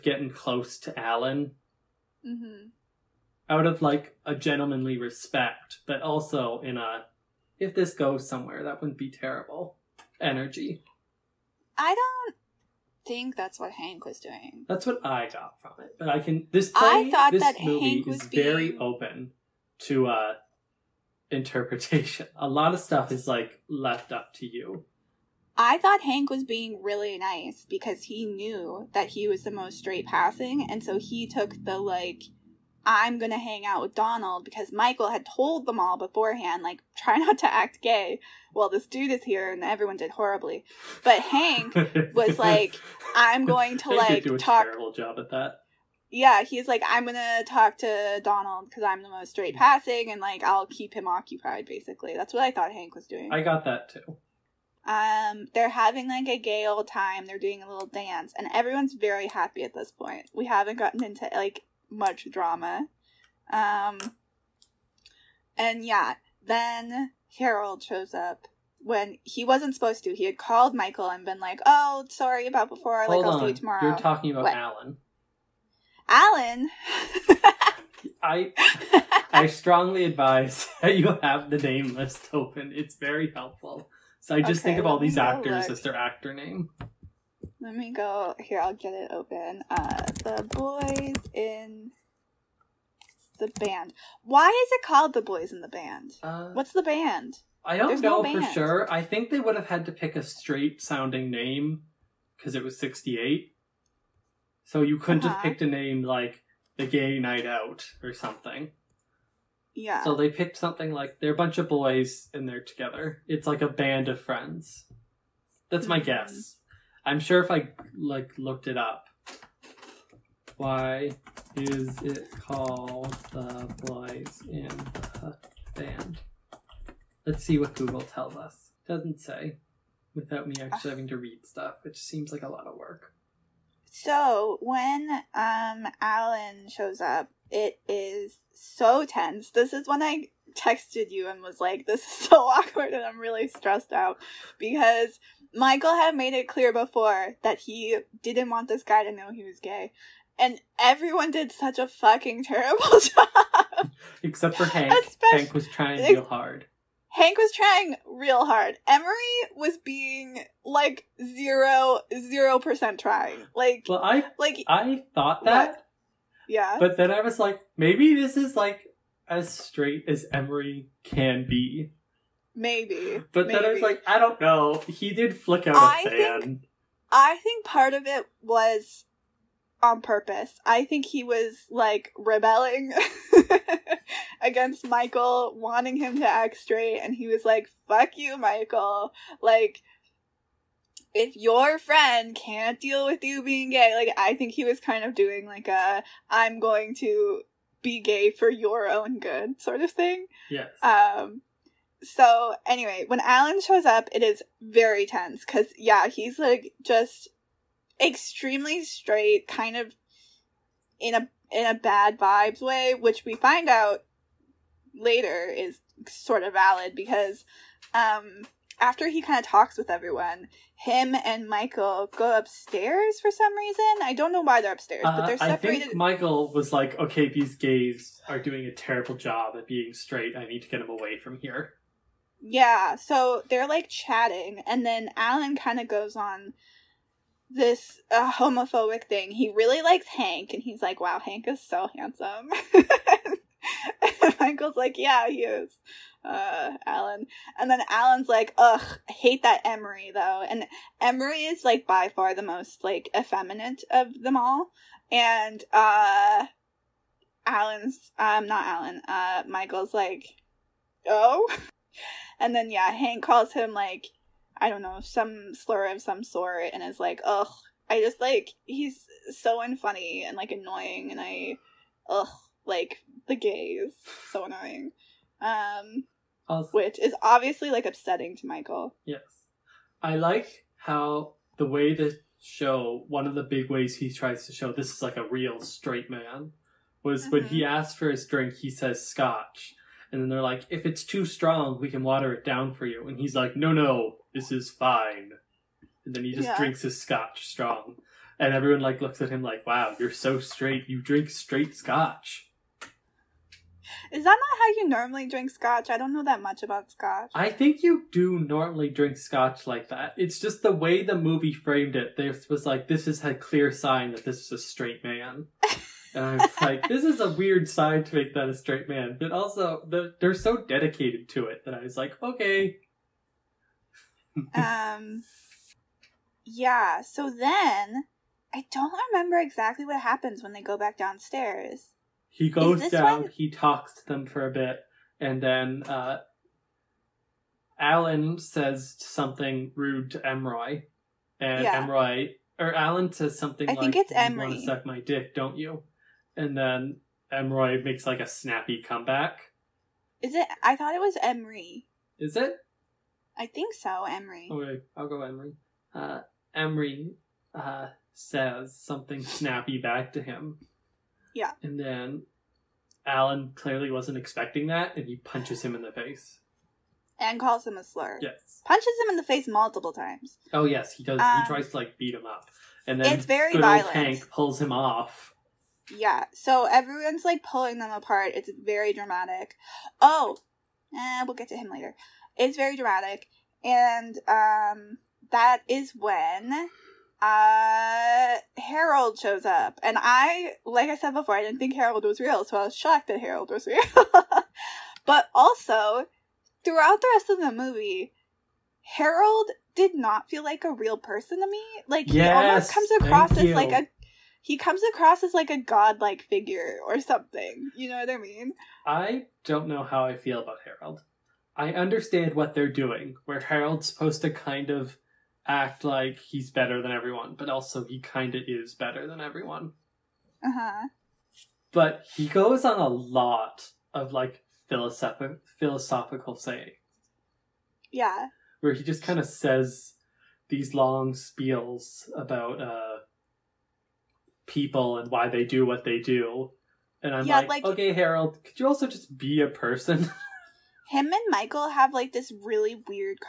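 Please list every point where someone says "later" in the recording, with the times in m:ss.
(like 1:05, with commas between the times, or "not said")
3:34, 6:21.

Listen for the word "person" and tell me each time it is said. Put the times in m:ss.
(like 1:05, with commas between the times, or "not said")
6:40, 7:19.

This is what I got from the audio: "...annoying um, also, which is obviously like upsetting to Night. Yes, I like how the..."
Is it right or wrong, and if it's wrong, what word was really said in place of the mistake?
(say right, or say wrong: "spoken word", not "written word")
wrong: "Michael", not "Night".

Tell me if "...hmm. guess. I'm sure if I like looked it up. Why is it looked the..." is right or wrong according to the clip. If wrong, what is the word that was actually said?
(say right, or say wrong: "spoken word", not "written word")
wrong: "called", not "looked".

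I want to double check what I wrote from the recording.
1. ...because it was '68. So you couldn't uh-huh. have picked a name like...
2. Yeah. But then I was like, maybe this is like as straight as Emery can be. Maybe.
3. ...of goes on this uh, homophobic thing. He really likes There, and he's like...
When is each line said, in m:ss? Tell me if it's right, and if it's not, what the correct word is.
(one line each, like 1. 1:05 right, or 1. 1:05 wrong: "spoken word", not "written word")
1. 1:42 right
2. 2:46 right
3. 3:55 wrong: "Hank", not "There".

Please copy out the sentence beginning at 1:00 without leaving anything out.
We haven't gotten into like much drama.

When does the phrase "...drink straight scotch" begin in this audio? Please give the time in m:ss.
5:01.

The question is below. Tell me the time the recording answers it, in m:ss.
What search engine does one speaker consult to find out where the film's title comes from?
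2:07.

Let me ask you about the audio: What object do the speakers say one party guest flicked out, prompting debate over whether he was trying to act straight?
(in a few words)
A fan.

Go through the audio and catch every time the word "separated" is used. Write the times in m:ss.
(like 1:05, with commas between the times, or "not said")
3:45.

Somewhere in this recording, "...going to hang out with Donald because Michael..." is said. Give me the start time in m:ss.
0:33.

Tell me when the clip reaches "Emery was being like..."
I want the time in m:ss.
2:38.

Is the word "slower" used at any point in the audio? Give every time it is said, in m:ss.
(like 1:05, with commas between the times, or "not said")
not said.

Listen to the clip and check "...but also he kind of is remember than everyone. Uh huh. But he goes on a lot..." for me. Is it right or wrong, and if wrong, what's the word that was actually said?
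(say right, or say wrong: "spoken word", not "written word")
wrong: "better", not "remember".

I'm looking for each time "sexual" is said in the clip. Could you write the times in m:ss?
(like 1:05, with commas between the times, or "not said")
not said.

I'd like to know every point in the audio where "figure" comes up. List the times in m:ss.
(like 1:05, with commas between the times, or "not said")
6:46.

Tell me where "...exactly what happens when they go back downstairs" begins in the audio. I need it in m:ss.
5:29.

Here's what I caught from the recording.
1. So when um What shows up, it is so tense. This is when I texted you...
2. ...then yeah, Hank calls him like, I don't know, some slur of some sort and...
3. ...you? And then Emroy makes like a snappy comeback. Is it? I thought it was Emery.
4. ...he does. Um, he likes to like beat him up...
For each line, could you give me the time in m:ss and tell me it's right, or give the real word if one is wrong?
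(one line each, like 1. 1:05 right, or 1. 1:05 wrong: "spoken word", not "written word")
1. 2:13 wrong: "Alan", not "What"
2. 4:22 right
3. 5:45 right
4. 6:10 wrong: "tries", not "likes".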